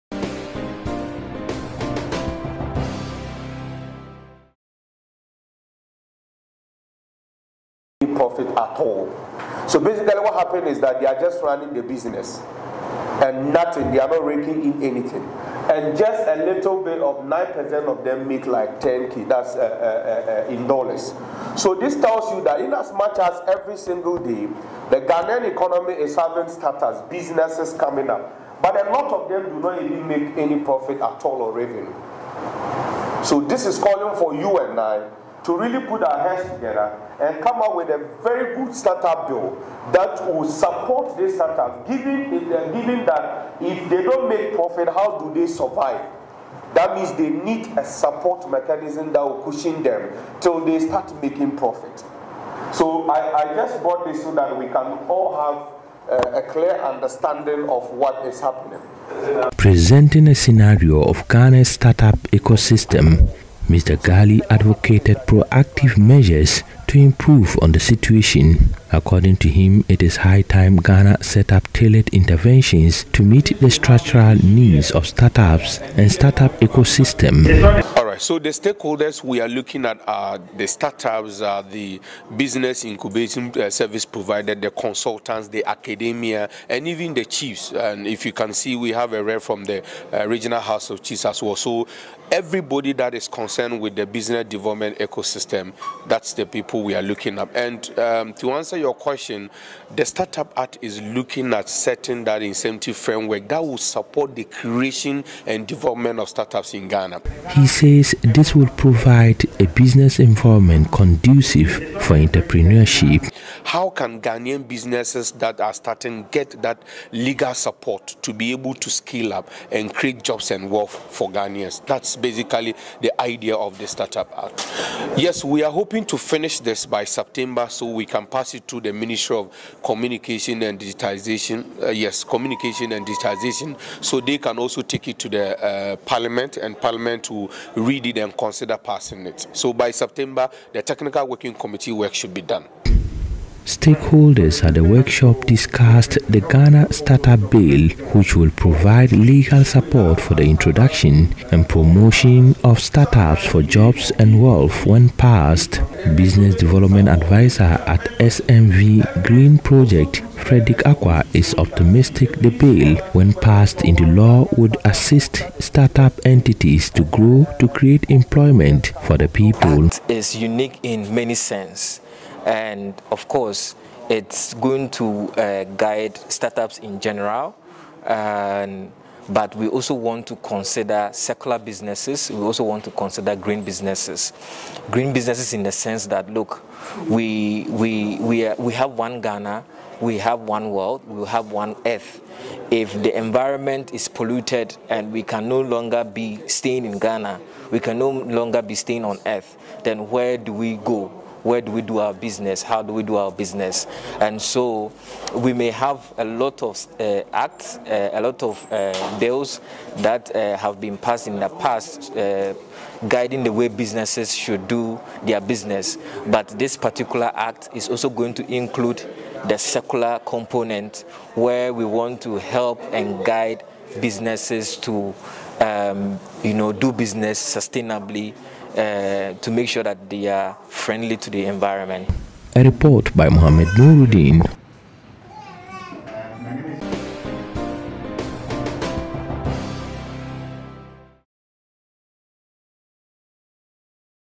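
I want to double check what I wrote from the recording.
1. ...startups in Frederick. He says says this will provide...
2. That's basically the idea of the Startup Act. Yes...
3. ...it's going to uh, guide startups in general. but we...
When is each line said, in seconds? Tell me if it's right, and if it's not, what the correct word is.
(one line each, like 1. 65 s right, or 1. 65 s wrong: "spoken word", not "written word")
1. 106 s wrong: "Ghana", not "Frederick"
2. 121 s right
3. 174 s right.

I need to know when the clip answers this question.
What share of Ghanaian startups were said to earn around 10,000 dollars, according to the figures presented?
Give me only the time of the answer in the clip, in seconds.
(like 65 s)
17 s.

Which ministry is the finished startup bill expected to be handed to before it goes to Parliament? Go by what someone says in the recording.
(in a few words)
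Ministry of Communication and Digitization.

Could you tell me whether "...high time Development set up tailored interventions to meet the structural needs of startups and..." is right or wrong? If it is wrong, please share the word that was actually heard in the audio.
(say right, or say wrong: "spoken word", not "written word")
wrong: "Ghana", not "Development".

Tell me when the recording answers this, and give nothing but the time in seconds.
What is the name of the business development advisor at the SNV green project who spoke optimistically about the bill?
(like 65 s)
160 s.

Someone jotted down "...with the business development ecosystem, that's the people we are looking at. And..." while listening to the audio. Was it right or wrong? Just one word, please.
right.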